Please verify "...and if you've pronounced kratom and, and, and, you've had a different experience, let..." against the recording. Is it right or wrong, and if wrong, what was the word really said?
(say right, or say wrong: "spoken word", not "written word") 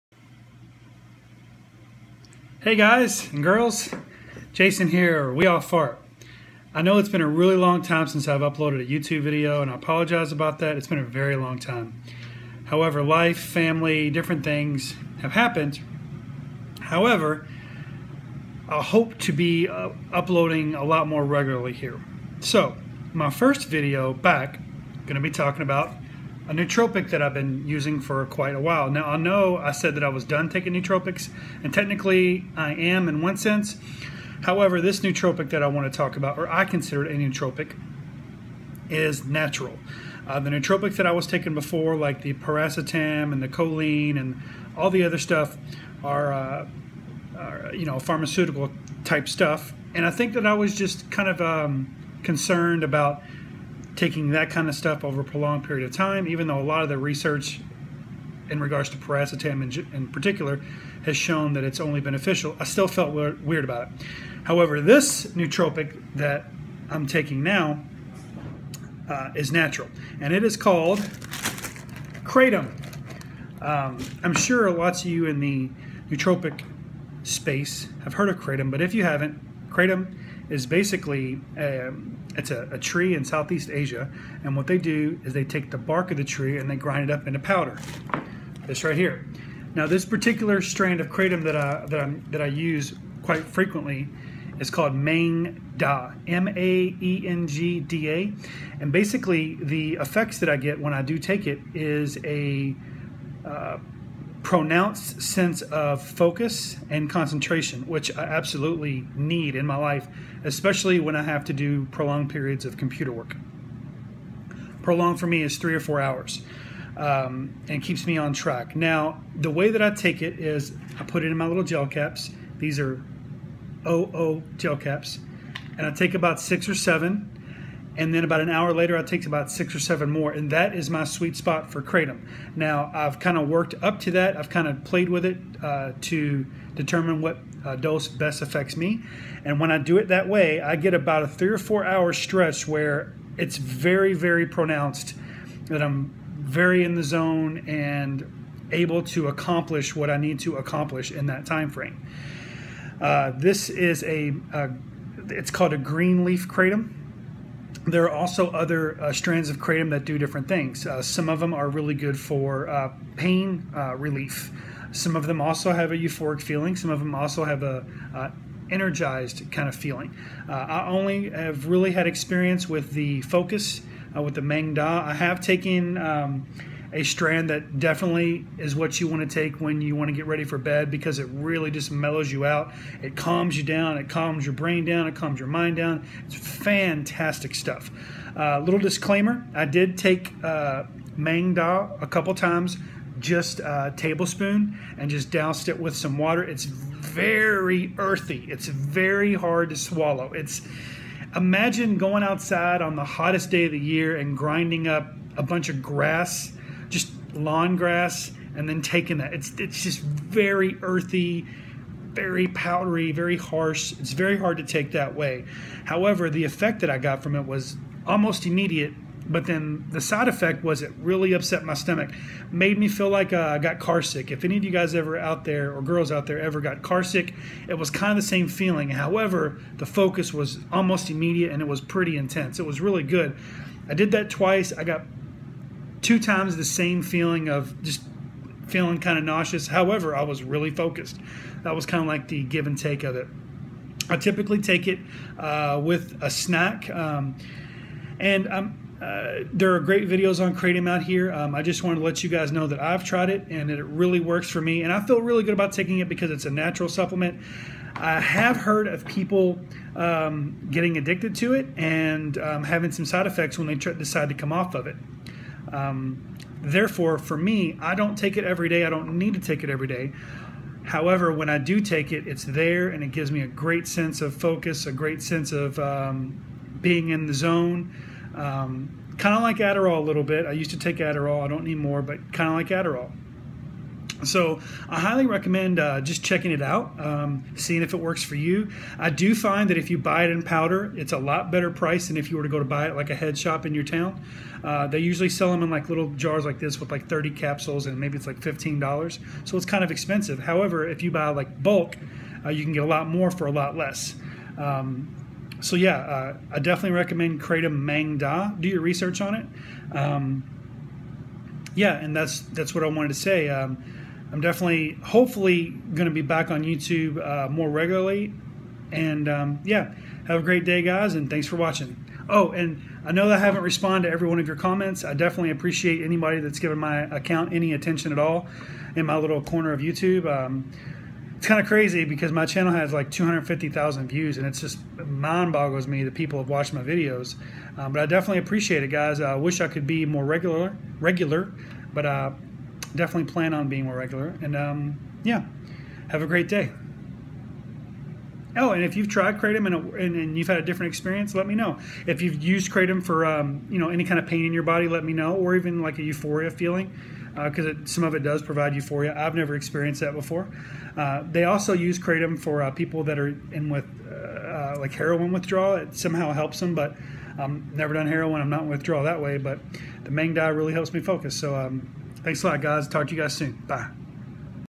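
wrong: "tried", not "pronounced".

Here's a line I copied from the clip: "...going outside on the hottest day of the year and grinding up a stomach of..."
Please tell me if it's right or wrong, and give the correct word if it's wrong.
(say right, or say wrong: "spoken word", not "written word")
wrong: "bunch", not "stomach".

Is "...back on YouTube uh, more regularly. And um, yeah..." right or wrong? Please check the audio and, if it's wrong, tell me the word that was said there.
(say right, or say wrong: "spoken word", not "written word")
right.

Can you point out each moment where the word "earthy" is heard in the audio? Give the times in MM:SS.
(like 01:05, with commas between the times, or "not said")
03:17, 03:30.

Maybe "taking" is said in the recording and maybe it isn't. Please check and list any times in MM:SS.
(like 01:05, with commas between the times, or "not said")
00:30, 00:41, 00:54, 01:07, 03:28, 04:15.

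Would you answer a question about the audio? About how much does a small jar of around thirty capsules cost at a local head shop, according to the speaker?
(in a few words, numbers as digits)
$15.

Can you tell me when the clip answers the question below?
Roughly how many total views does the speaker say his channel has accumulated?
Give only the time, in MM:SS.
05:33.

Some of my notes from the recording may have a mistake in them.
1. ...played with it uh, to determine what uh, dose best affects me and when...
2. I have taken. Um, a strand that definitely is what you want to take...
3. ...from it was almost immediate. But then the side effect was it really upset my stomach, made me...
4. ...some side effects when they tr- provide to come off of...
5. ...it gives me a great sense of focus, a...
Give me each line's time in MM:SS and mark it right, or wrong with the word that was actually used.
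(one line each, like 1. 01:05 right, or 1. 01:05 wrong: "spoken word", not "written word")
1. 02:14 right
2. 02:55 right
3. 03:37 right
4. 04:22 wrong: "decide", not "provide"
5. 04:33 right.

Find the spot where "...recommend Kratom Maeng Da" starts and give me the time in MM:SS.
05:06.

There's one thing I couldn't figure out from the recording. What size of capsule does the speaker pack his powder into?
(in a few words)
OO.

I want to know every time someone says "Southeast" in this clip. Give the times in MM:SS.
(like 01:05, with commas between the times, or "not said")
01:23.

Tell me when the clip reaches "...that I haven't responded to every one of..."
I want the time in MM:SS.
05:23.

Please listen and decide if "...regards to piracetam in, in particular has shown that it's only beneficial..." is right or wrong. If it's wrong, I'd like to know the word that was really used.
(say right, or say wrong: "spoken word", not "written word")
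right.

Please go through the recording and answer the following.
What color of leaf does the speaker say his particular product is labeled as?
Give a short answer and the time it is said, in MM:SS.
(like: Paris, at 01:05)
green, at 02:35.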